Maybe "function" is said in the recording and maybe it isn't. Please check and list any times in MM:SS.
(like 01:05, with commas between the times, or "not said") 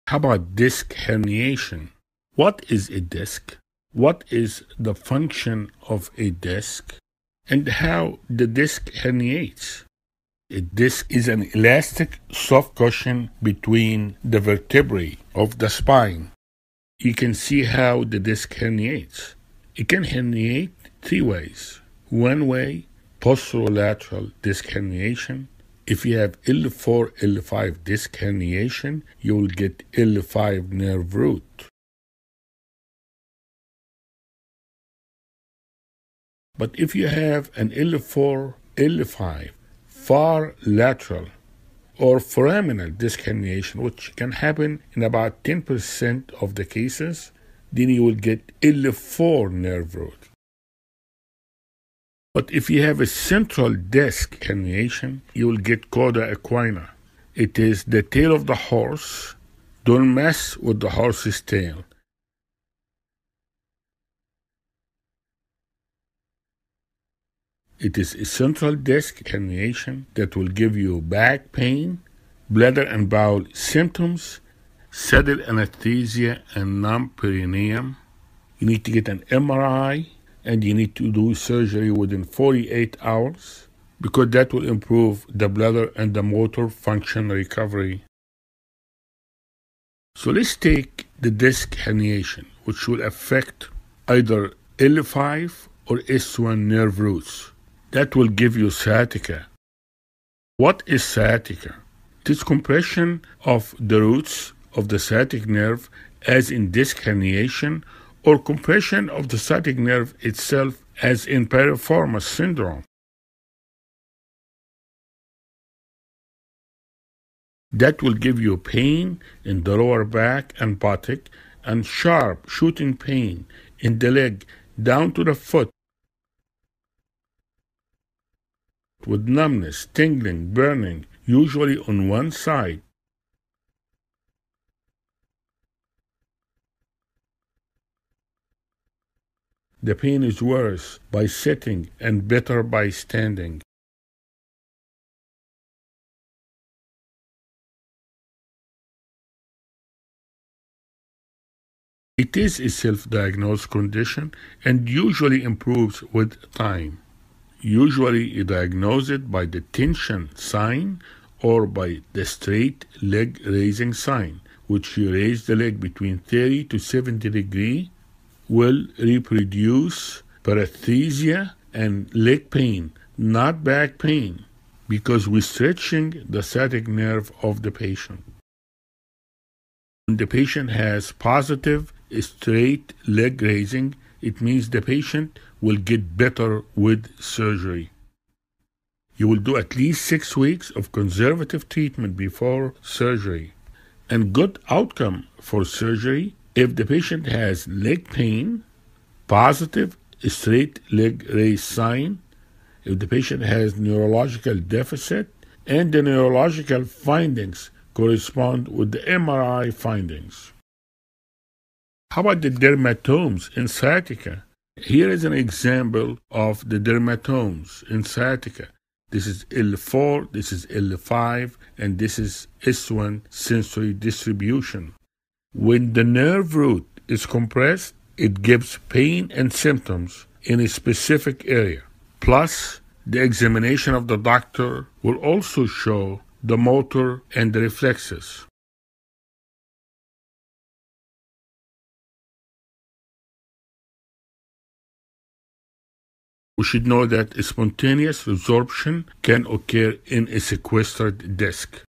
00:04, 01:26.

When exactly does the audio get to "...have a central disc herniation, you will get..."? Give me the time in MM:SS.
00:52.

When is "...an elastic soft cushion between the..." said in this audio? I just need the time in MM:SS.
00:11.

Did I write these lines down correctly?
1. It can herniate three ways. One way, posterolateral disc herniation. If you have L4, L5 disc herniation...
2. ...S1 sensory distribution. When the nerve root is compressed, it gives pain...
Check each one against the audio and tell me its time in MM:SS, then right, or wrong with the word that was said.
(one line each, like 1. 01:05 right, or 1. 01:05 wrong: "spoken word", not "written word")
1. 00:19 right
2. 03:42 right.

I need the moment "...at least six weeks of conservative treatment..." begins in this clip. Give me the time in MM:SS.
03:09.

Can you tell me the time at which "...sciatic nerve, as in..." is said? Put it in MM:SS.
01:44.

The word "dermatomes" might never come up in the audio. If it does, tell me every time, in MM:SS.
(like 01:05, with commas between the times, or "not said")
03:32, 03:36.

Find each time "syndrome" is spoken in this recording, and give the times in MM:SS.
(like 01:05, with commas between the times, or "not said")
01:52.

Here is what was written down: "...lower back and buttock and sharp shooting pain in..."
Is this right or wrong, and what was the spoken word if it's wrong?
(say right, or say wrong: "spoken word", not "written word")
right.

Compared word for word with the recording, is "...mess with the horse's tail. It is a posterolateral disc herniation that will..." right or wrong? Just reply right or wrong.
wrong.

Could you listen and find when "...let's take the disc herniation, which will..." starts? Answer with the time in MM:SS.
01:30.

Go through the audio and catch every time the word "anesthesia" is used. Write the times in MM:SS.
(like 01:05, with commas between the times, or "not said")
01:15.